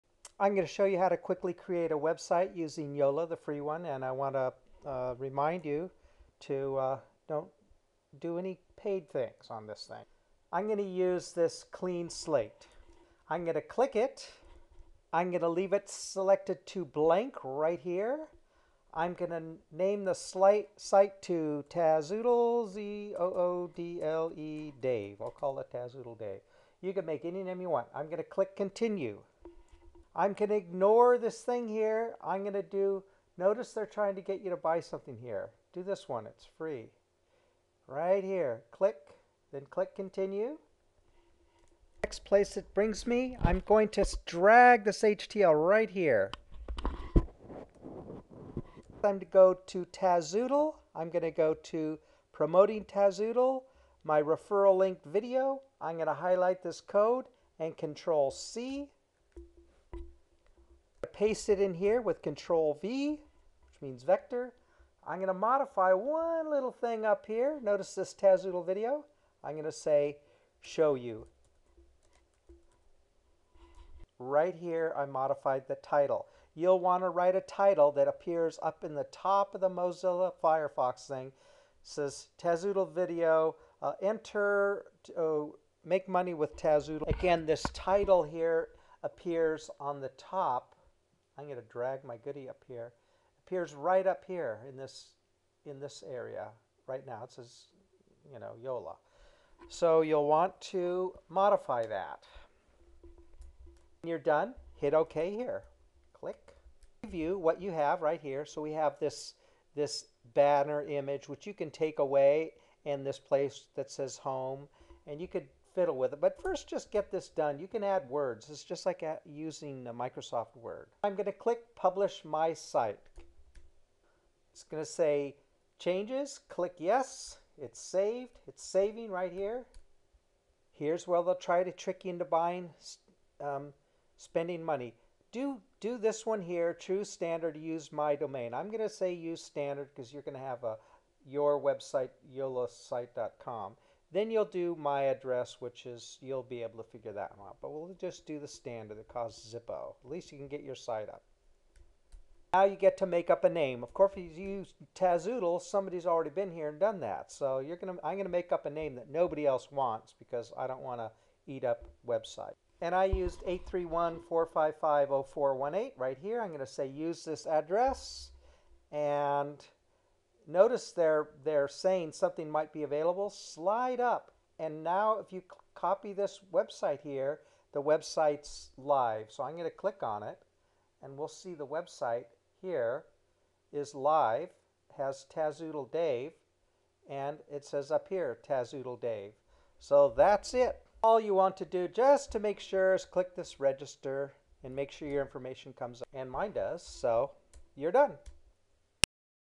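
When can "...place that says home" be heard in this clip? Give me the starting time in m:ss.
1:53.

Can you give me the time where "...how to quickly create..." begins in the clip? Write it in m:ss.
0:00.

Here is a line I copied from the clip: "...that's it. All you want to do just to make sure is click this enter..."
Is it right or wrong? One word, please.
wrong.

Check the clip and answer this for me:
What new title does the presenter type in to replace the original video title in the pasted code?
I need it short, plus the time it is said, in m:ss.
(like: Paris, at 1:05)
make money with Tazoodle, at 1:25.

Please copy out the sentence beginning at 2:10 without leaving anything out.
Here's where they'll try to trick you into buying, um, spending money.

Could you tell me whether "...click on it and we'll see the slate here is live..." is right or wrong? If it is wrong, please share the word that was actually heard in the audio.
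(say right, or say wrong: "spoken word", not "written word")
wrong: "website", not "slate".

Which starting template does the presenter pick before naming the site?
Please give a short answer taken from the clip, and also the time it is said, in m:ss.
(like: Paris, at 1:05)
clean slate, at 0:11.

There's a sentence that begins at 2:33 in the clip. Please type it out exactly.
Of course, if you use Tazoodle, somebody's already been here and done that.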